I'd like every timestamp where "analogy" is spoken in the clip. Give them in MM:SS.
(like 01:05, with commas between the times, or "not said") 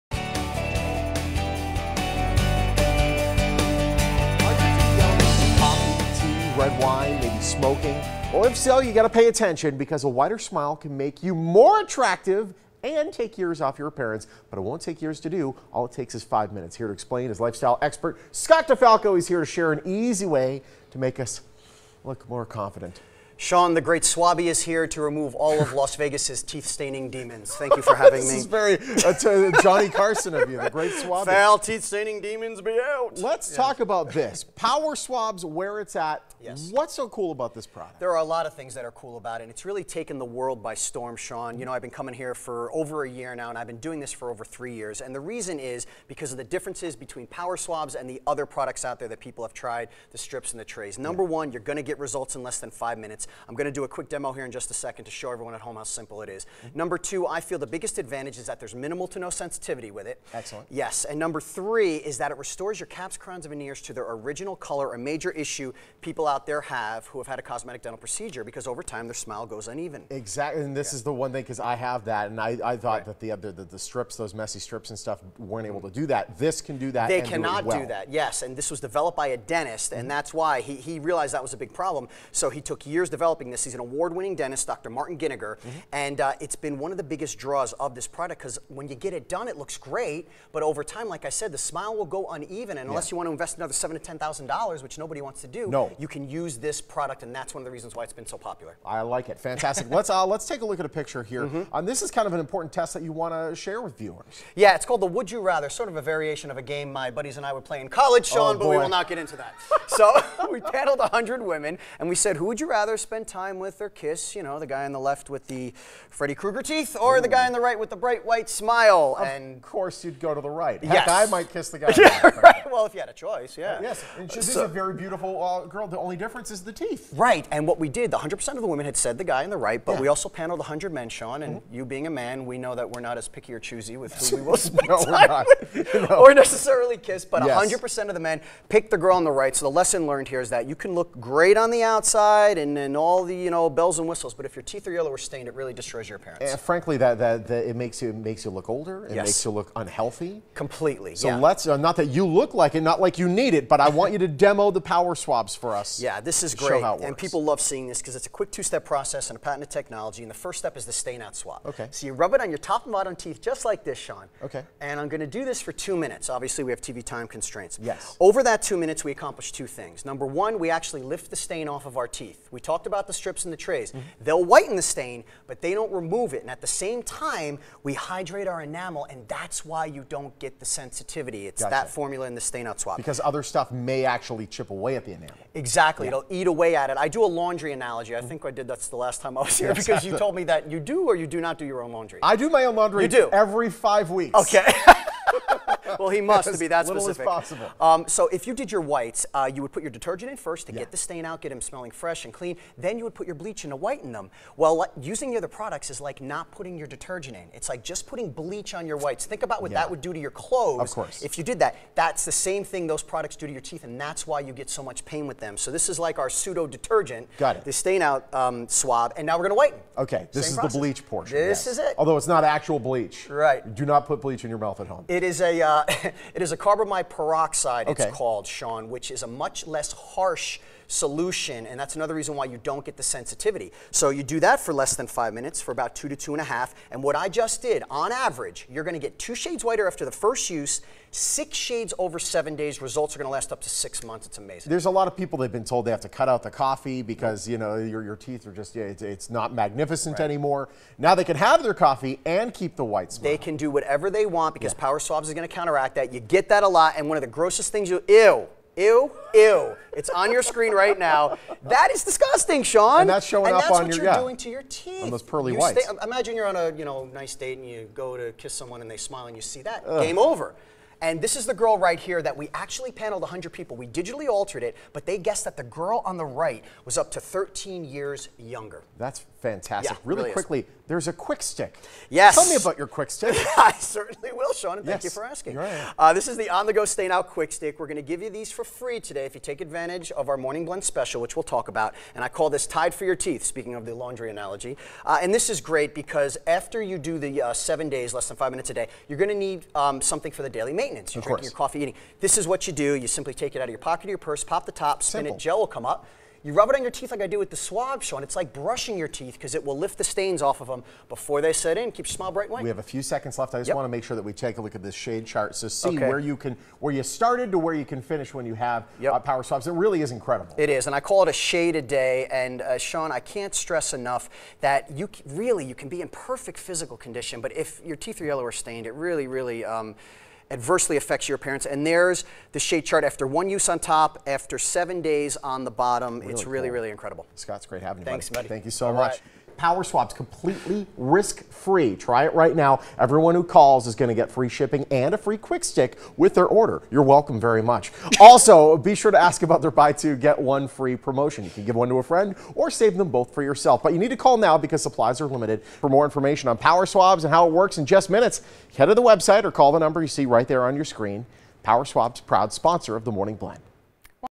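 03:07, 04:54.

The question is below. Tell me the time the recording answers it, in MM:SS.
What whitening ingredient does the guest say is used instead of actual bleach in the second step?
03:46.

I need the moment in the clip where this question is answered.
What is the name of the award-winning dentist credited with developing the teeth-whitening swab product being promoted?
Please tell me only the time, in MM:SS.
01:24.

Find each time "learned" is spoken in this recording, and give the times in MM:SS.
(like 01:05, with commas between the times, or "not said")
02:20.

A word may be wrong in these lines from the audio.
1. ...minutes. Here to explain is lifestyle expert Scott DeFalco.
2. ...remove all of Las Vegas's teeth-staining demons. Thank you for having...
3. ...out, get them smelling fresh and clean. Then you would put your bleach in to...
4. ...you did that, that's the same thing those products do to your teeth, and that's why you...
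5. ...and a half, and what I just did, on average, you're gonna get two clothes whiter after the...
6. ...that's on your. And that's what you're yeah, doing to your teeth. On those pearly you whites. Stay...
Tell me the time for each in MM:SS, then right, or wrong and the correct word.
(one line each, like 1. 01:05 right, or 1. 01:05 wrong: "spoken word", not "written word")
1. 00:16 right
2. 00:25 right
3. 03:21 right
4. 03:31 right
5. 03:56 wrong: "shades", not "clothes"
6. 04:23 right.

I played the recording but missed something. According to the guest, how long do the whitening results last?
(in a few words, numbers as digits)
up to 6 months.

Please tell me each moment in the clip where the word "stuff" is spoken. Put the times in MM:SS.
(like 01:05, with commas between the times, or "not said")
01:14, 03:03.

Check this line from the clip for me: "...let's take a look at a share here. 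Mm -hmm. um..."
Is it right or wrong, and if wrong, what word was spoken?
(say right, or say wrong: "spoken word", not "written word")
wrong: "picture", not "share".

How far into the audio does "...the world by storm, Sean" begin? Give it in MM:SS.
00:40.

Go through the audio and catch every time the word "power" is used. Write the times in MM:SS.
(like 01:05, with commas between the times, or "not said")
00:34, 00:47, 02:34, 04:14, 05:19, 05:39, 05:56, 06:01.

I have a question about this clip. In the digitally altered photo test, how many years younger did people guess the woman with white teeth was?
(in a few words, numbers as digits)
13 years.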